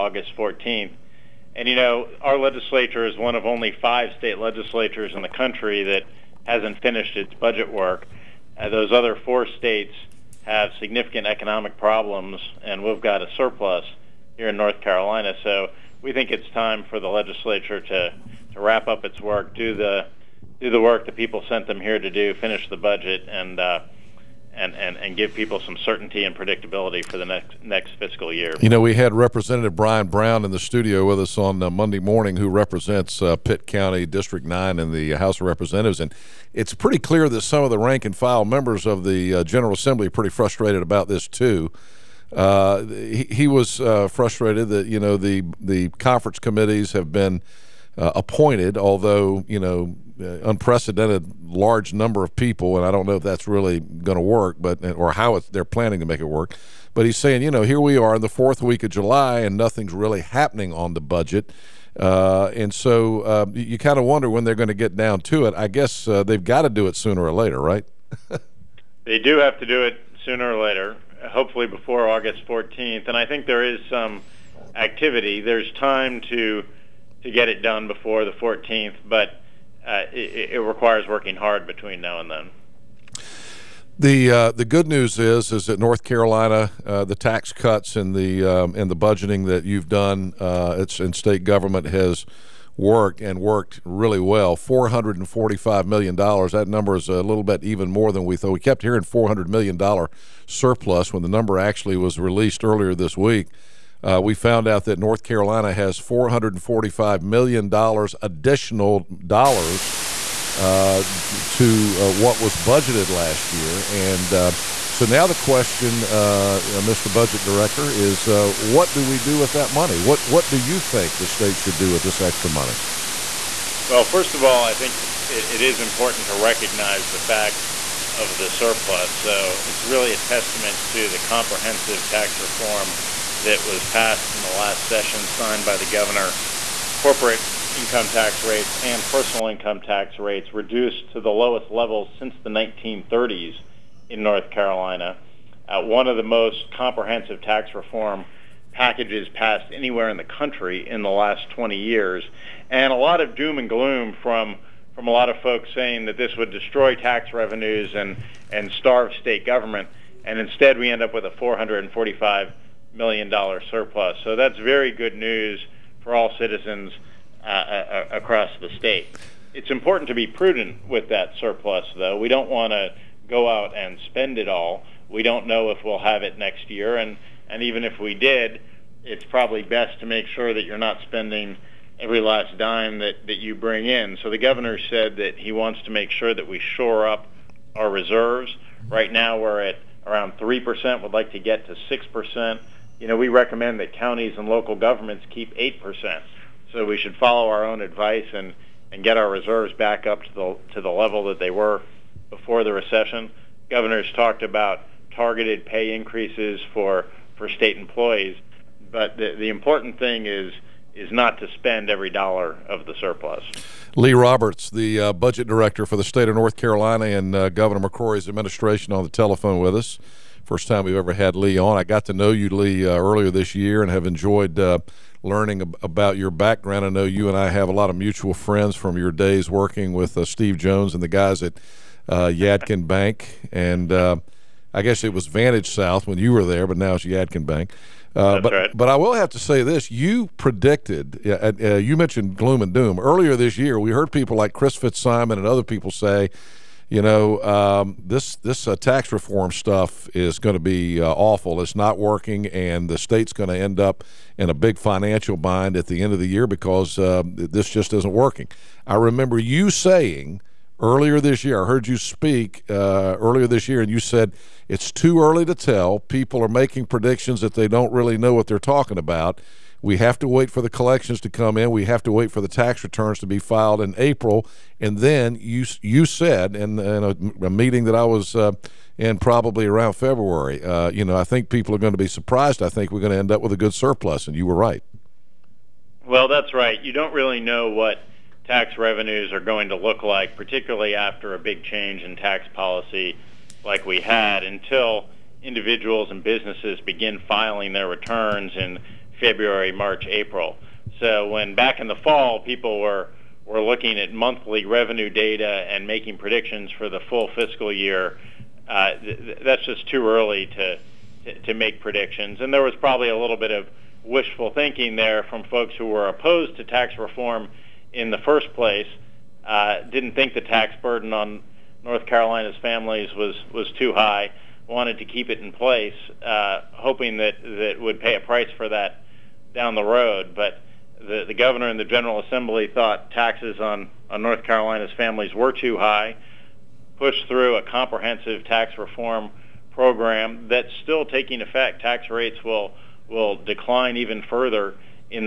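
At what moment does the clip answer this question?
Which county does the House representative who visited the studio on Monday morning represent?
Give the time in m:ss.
0:33.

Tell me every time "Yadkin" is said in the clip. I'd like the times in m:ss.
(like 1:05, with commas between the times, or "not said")
3:52, 3:57.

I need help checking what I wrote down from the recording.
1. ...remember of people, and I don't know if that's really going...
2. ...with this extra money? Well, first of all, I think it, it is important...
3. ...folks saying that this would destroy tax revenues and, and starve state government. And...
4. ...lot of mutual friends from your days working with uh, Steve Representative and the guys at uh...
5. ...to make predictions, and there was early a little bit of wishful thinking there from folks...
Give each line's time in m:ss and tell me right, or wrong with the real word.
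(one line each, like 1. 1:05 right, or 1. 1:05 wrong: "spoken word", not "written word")
1. 0:51 wrong: "number", not "remember"
2. 2:01 right
3. 2:35 right
4. 3:47 wrong: "Jones", not "Representative"
5. 5:11 wrong: "probably", not "early".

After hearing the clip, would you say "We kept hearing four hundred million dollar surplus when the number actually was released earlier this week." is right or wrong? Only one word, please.
right.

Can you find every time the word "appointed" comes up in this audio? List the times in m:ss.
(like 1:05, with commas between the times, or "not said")
0:48.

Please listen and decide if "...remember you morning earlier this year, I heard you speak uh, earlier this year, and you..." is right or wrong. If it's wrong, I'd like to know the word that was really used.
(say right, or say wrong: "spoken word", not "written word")
wrong: "saying", not "morning".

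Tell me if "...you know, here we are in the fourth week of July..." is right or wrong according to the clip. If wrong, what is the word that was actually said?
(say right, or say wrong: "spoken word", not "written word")
right.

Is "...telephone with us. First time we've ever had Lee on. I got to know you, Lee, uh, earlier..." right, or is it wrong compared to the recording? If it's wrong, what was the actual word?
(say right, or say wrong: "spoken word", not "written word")
right.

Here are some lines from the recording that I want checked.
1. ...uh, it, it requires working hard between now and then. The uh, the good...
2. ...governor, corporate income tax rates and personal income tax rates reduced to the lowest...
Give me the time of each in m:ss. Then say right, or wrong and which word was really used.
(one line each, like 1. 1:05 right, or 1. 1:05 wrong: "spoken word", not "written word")
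1. 1:19 right
2. 2:15 right.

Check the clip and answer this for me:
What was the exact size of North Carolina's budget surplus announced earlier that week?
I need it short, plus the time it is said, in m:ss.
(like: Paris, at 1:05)
$445 million, at 1:34.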